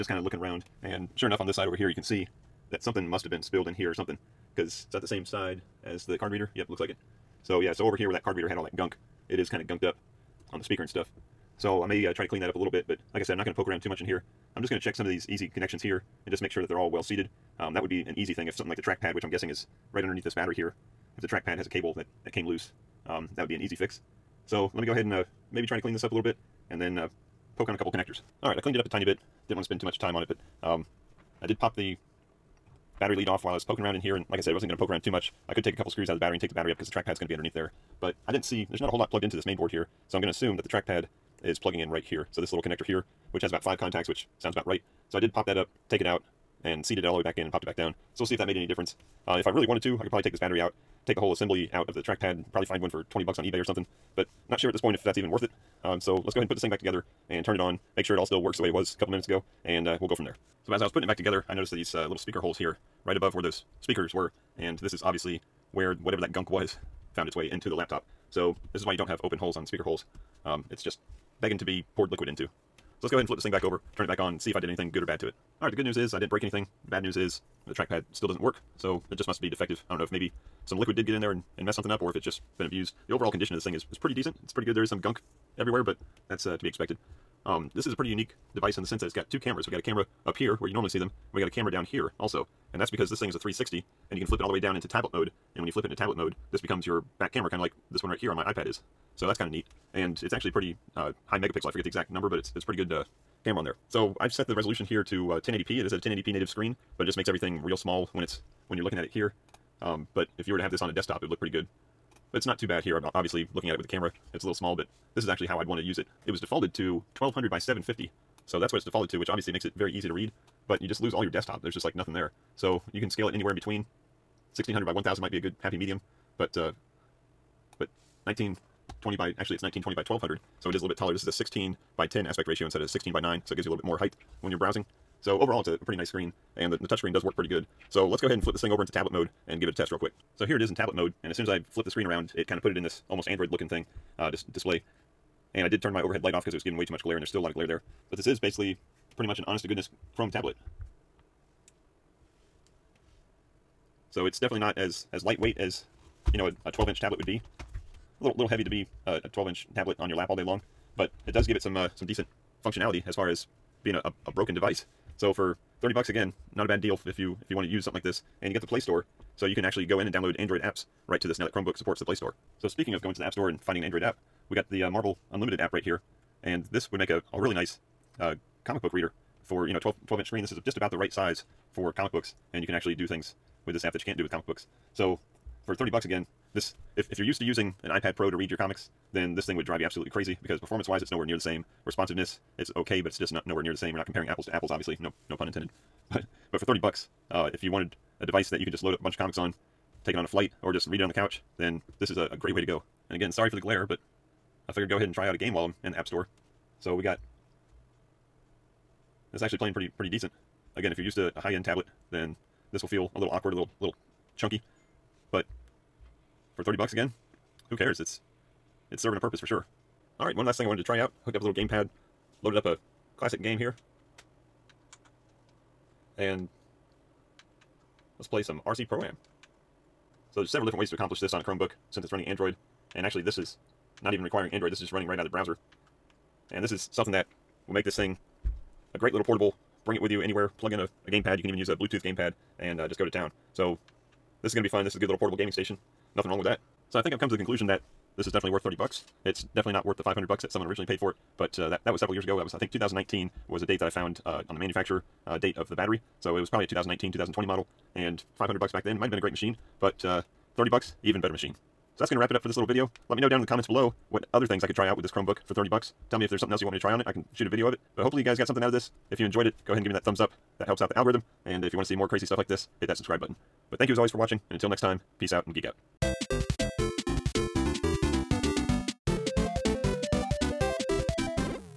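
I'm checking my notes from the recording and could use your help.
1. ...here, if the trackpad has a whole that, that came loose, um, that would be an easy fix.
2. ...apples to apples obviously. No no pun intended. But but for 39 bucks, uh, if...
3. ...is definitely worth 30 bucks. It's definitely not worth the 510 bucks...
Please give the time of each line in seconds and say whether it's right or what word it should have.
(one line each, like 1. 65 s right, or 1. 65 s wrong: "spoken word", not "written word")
1. 20 s wrong: "cable", not "whole"
2. 194 s wrong: "30", not "39"
3. 248 s wrong: "500", not "510".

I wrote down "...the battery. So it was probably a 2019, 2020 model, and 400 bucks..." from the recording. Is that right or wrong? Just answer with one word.
wrong.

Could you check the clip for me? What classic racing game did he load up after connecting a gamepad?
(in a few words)
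RC Pro-Am.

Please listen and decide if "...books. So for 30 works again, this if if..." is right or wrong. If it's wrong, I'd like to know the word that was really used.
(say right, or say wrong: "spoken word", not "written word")
wrong: "bucks", not "works".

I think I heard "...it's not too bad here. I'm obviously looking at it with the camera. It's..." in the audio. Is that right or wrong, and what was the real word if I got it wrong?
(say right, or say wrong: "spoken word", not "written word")
right.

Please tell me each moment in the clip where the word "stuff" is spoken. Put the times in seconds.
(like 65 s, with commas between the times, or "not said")
10 s, 272 s.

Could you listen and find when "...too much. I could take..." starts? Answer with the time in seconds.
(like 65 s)
35 s.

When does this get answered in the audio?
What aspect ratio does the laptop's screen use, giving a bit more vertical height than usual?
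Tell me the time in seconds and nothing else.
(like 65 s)
131 s.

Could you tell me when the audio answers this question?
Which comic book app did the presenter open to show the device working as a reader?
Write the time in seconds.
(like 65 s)
174 s.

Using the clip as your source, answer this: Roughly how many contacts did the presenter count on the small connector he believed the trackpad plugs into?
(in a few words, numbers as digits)
5.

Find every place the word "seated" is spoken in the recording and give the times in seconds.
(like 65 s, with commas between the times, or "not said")
17 s, 46 s.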